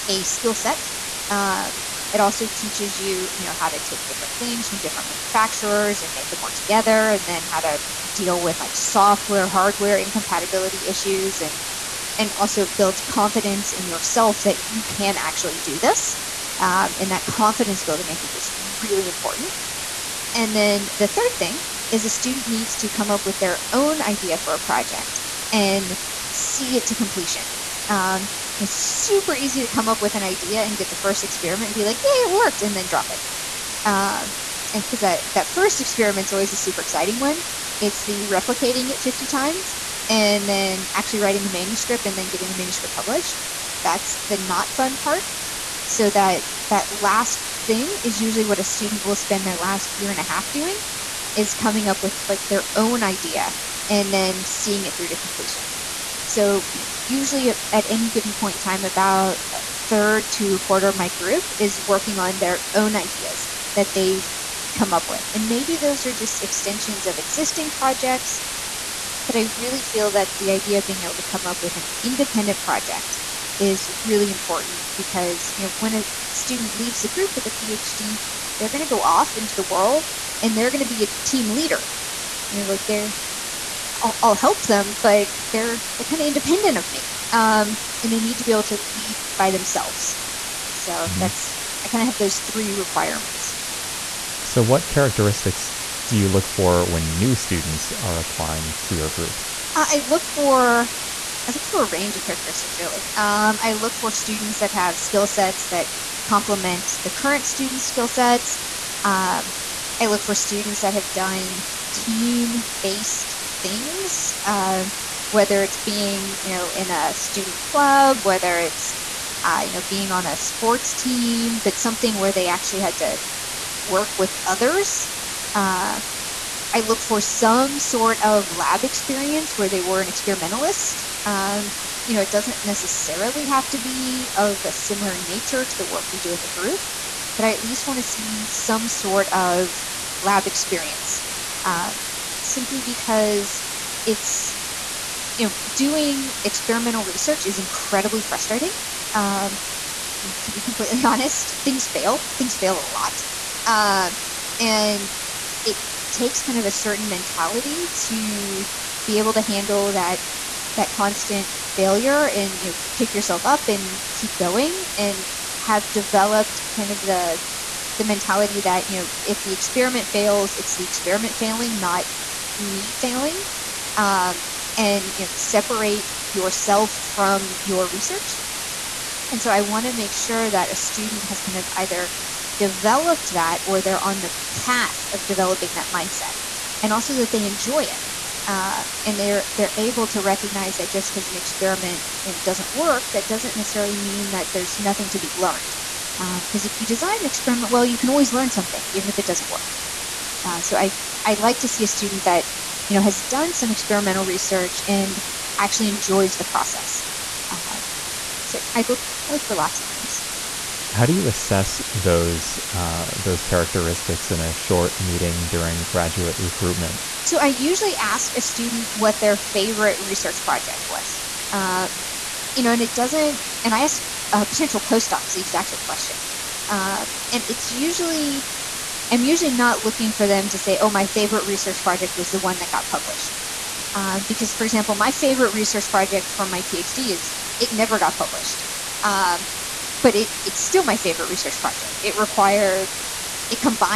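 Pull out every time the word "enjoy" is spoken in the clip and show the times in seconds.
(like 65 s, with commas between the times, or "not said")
187 s, 205 s.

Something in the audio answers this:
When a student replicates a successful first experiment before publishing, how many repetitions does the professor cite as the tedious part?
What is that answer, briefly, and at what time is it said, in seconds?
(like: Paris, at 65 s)
50, at 38 s.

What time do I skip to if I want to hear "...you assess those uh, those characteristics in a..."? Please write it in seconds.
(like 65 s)
211 s.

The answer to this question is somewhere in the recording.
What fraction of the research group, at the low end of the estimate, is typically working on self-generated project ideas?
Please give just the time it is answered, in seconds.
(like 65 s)
60 s.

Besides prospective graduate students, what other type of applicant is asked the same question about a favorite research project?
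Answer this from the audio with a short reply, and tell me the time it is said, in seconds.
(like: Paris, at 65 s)
postdocs, at 224 s.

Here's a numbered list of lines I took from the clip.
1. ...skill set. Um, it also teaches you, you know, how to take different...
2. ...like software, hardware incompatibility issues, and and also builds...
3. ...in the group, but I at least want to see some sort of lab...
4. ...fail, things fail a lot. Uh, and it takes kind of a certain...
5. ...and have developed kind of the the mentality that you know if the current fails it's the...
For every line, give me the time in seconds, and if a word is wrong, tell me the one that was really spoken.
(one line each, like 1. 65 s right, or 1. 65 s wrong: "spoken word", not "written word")
1. 0 s right
2. 8 s right
3. 136 s right
4. 151 s right
5. 164 s wrong: "experiment", not "current".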